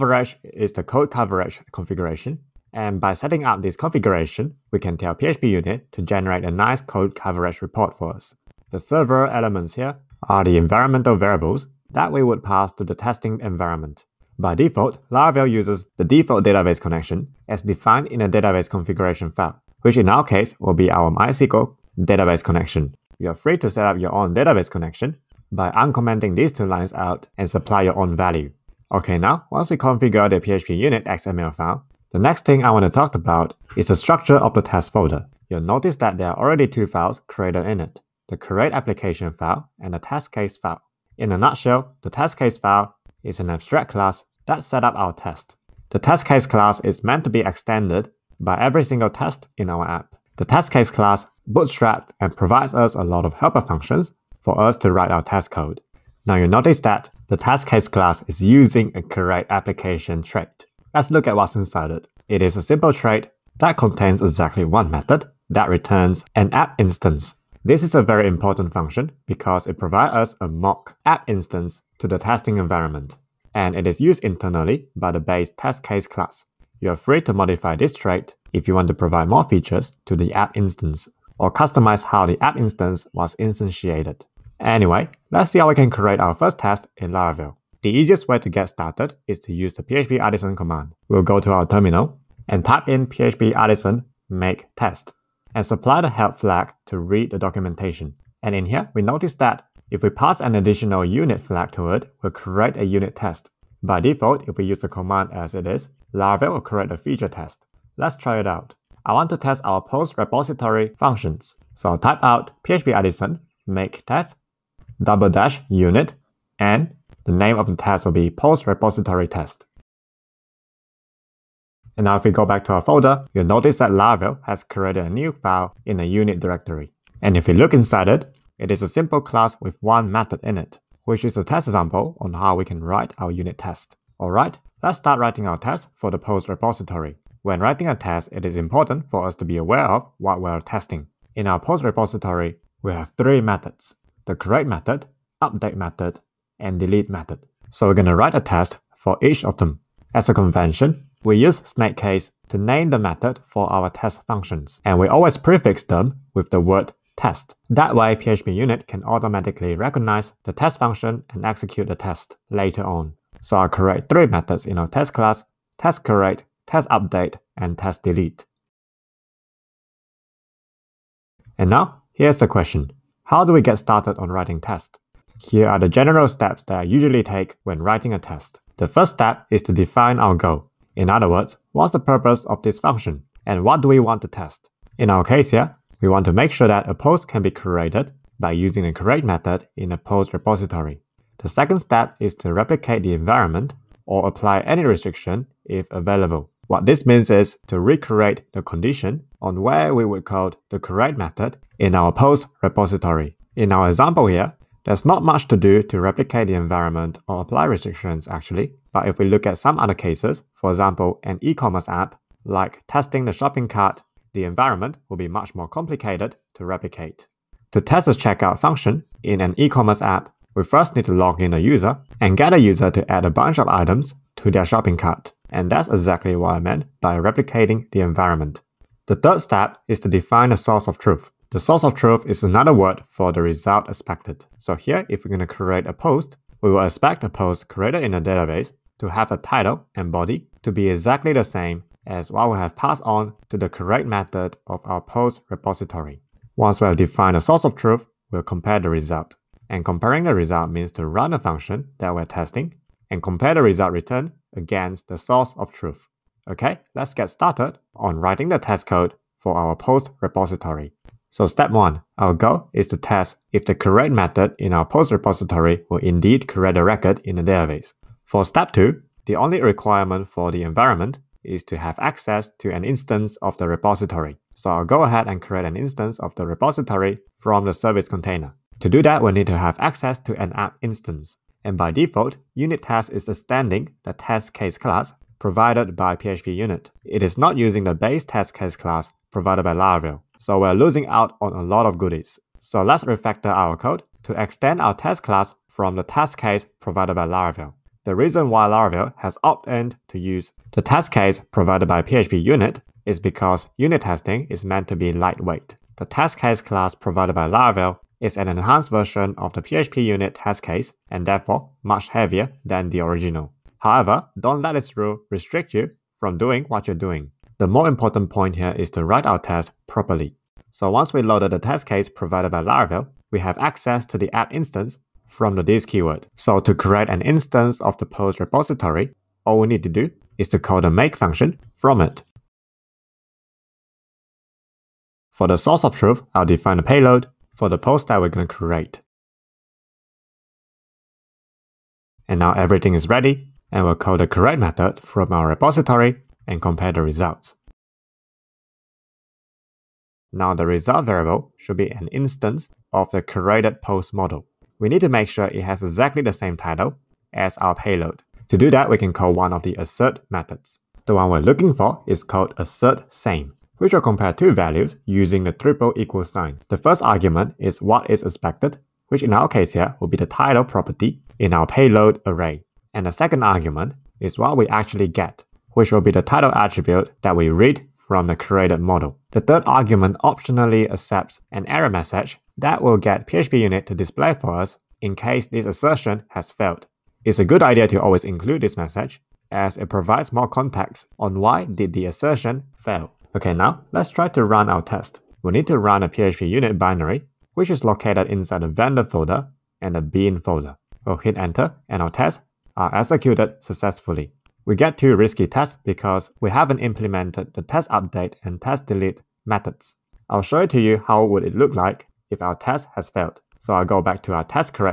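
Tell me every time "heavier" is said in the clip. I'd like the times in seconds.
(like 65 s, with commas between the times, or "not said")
312 s.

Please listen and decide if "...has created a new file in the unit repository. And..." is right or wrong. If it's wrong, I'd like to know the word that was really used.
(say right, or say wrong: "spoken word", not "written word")
wrong: "directory", not "repository".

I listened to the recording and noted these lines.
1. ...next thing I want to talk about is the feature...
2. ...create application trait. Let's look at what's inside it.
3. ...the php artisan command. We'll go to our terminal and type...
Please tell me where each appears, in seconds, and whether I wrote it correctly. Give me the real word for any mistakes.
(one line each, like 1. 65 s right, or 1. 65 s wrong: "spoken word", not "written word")
1. 32 s wrong: "structure", not "feature"
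2. 59 s right
3. 89 s right.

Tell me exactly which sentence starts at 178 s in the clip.
The first step is to define our goal.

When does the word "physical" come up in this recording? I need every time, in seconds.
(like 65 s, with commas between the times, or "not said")
not said.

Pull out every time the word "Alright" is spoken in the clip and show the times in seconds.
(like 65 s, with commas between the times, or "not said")
134 s.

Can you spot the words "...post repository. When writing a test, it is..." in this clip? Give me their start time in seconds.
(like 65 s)
136 s.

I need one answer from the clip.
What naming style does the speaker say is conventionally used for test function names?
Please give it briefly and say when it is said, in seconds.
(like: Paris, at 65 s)
snake case, at 151 s.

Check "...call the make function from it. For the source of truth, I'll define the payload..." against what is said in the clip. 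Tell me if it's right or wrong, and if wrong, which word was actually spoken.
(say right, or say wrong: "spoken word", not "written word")
right.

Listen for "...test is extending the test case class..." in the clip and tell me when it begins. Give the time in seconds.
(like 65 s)
282 s.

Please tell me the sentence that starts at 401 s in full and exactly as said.
We'll hit enter and our tests are executed successfully.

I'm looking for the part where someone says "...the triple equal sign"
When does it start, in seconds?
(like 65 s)
365 s.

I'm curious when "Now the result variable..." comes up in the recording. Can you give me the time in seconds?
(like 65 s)
350 s.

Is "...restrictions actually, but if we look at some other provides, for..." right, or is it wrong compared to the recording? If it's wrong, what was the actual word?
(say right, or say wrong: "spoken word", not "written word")
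wrong: "cases", not "provides".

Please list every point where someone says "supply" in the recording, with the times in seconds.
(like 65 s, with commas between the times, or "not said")
27 s, 95 s.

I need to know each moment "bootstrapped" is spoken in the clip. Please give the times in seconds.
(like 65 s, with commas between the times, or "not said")
51 s.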